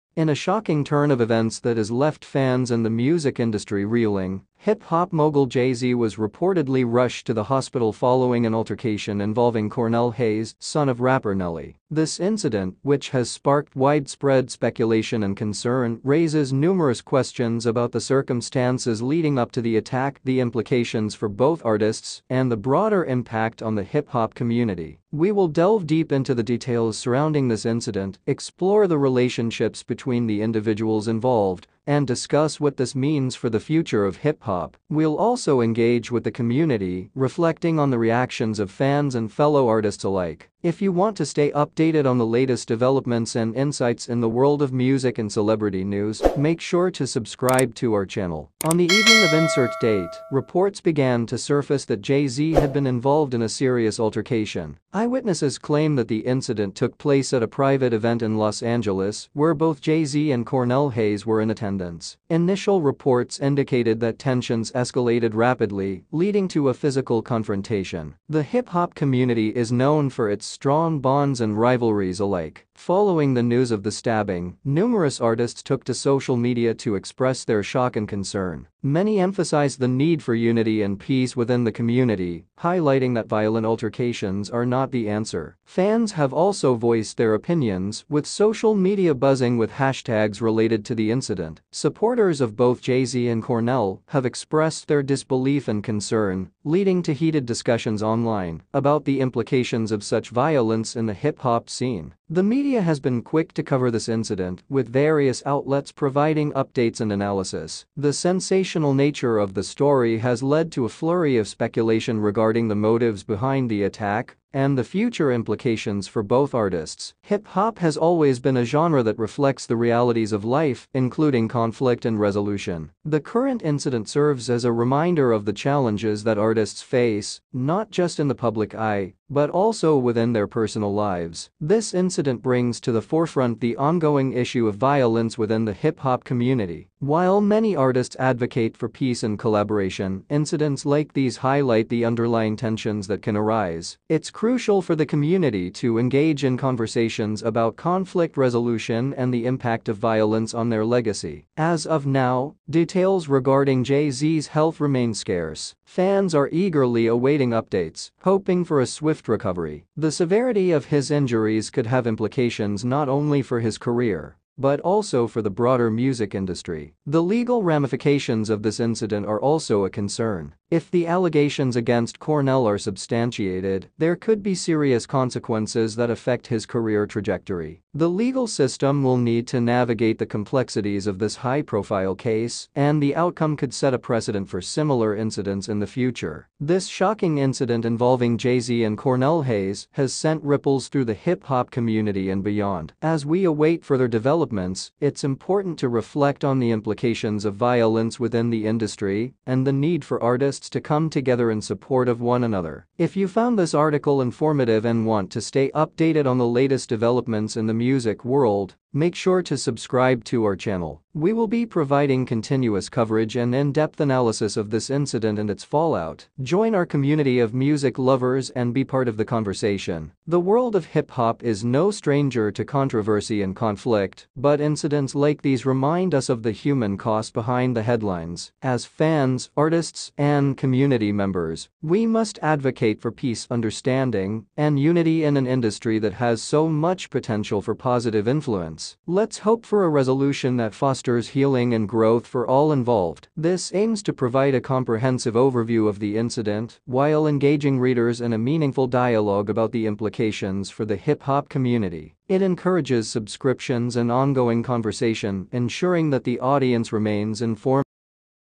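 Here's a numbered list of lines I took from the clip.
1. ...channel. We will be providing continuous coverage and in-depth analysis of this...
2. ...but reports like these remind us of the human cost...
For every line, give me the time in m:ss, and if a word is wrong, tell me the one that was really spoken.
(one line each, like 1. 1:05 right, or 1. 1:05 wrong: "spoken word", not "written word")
1. 3:30 right
2. 3:44 wrong: "incidents", not "reports".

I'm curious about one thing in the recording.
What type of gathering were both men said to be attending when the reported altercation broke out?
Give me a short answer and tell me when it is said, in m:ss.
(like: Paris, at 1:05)
A private event, at 0:57.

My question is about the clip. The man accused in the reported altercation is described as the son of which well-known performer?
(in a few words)
Nelly.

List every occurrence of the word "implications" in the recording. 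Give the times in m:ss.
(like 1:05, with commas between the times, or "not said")
0:20, 1:39, 1:55, 2:42, 3:16, 4:09.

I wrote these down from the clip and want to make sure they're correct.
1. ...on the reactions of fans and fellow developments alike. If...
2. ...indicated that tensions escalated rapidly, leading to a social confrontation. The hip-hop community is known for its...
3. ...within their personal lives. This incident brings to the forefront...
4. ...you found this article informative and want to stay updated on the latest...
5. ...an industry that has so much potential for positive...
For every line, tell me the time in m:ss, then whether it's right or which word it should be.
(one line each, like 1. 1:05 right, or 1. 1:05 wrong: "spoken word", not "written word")
1. 0:37 wrong: "artists", not "developments"
2. 1:03 wrong: "physical", not "social"
3. 2:09 right
4. 3:23 right
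5. 3:55 right.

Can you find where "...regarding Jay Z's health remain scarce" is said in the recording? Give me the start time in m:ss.
2:33.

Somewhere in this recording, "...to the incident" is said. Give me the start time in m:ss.
1:30.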